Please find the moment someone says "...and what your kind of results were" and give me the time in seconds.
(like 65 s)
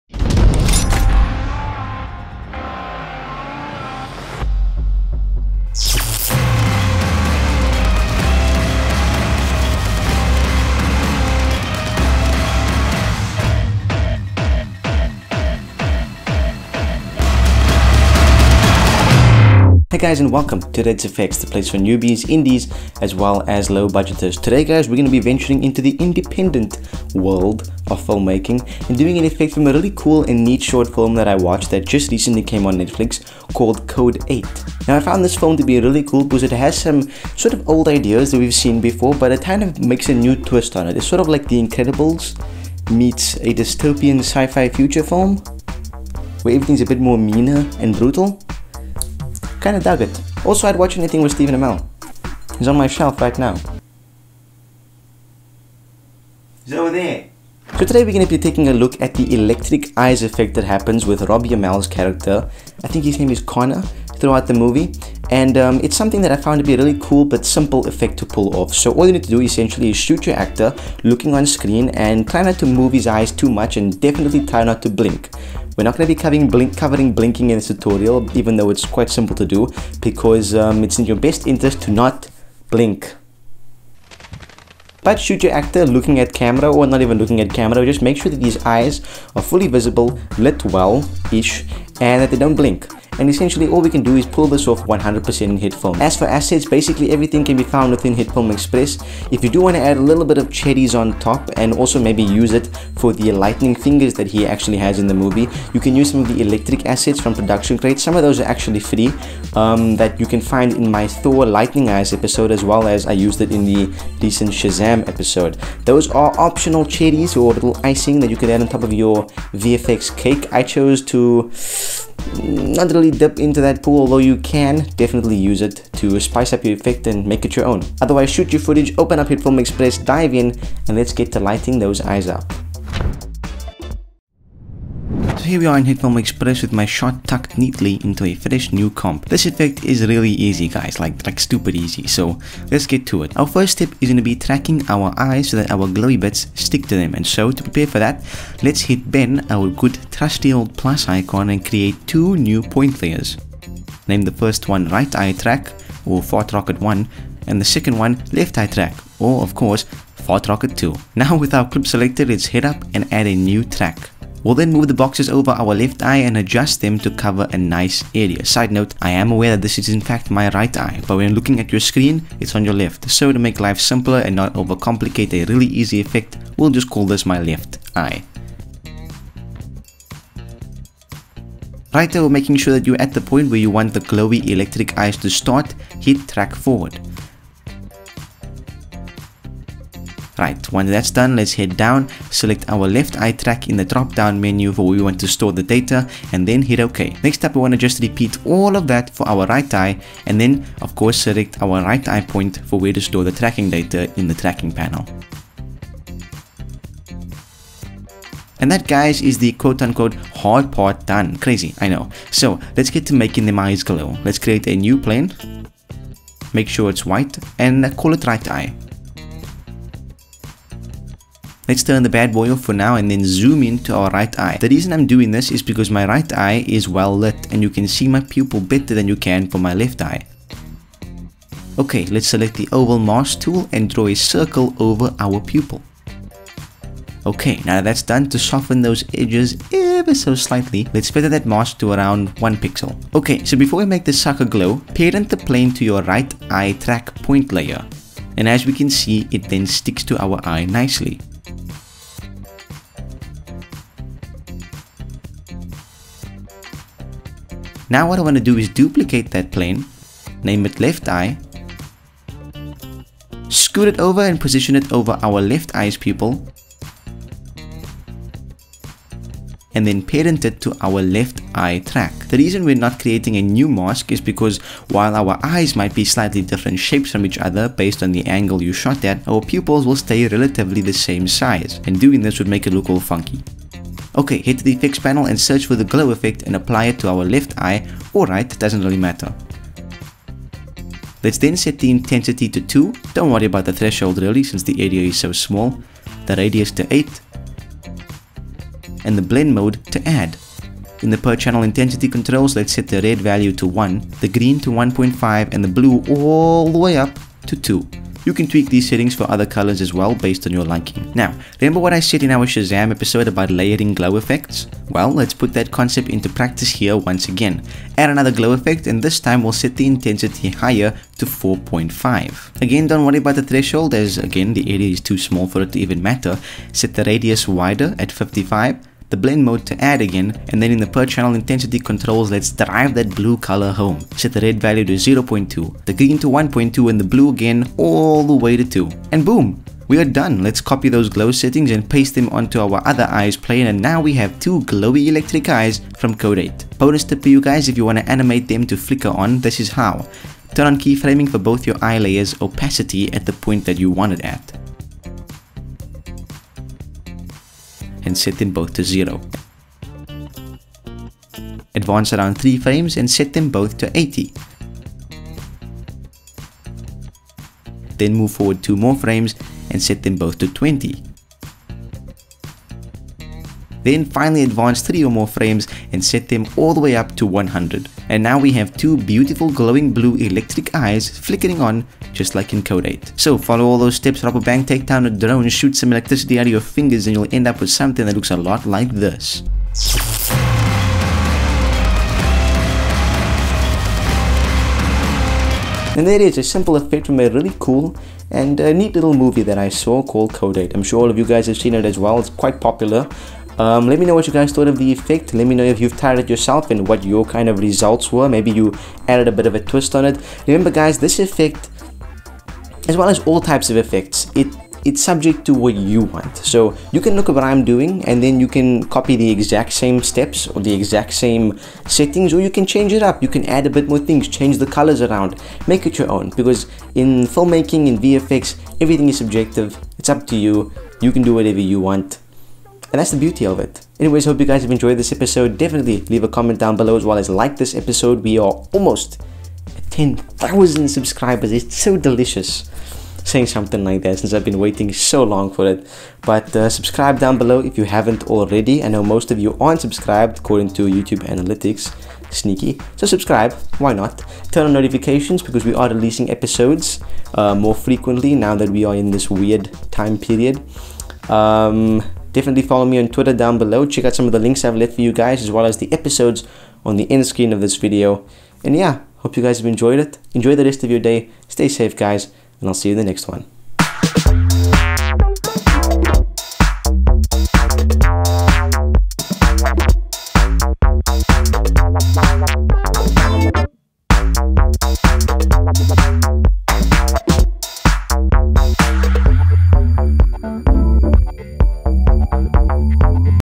406 s.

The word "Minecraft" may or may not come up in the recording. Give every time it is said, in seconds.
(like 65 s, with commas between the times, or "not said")
not said.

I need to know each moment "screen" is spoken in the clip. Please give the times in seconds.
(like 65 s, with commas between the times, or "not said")
71 s, 171 s, 467 s.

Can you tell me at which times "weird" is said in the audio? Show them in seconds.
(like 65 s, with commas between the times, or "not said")
459 s.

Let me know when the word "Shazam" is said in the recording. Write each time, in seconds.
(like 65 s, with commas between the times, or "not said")
114 s, 312 s.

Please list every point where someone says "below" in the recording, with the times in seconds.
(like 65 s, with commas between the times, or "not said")
436 s, 447 s, 463 s.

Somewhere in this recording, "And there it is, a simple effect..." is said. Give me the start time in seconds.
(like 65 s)
395 s.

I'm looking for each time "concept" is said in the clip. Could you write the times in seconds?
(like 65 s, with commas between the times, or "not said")
315 s.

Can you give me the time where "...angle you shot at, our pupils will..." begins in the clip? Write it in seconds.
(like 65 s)
278 s.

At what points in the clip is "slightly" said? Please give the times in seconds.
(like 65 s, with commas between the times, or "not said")
240 s, 276 s.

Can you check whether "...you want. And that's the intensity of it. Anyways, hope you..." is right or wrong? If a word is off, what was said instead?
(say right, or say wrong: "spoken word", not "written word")
wrong: "beauty", not "intensity".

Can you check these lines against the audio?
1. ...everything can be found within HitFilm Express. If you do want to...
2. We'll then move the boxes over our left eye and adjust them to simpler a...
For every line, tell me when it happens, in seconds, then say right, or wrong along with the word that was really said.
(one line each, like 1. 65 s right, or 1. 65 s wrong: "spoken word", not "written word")
1. 97 s right
2. 164 s wrong: "cover", not "simpler".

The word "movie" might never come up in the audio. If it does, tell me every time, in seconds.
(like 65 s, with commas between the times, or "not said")
64 s, 105 s, 399 s.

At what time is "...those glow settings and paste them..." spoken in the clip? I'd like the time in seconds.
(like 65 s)
340 s.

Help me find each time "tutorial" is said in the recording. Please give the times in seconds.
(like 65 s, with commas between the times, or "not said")
77 s.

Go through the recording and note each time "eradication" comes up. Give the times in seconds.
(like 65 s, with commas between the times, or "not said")
not said.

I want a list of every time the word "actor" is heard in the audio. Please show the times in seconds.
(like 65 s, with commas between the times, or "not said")
70 s, 85 s.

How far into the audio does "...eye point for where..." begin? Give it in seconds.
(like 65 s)
202 s.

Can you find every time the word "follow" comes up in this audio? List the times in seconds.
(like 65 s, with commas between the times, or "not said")
383 s, 462 s.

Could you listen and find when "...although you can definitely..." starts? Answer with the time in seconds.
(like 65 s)
124 s.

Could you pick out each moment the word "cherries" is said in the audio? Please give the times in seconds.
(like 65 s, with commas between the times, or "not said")
100 s, 116 s.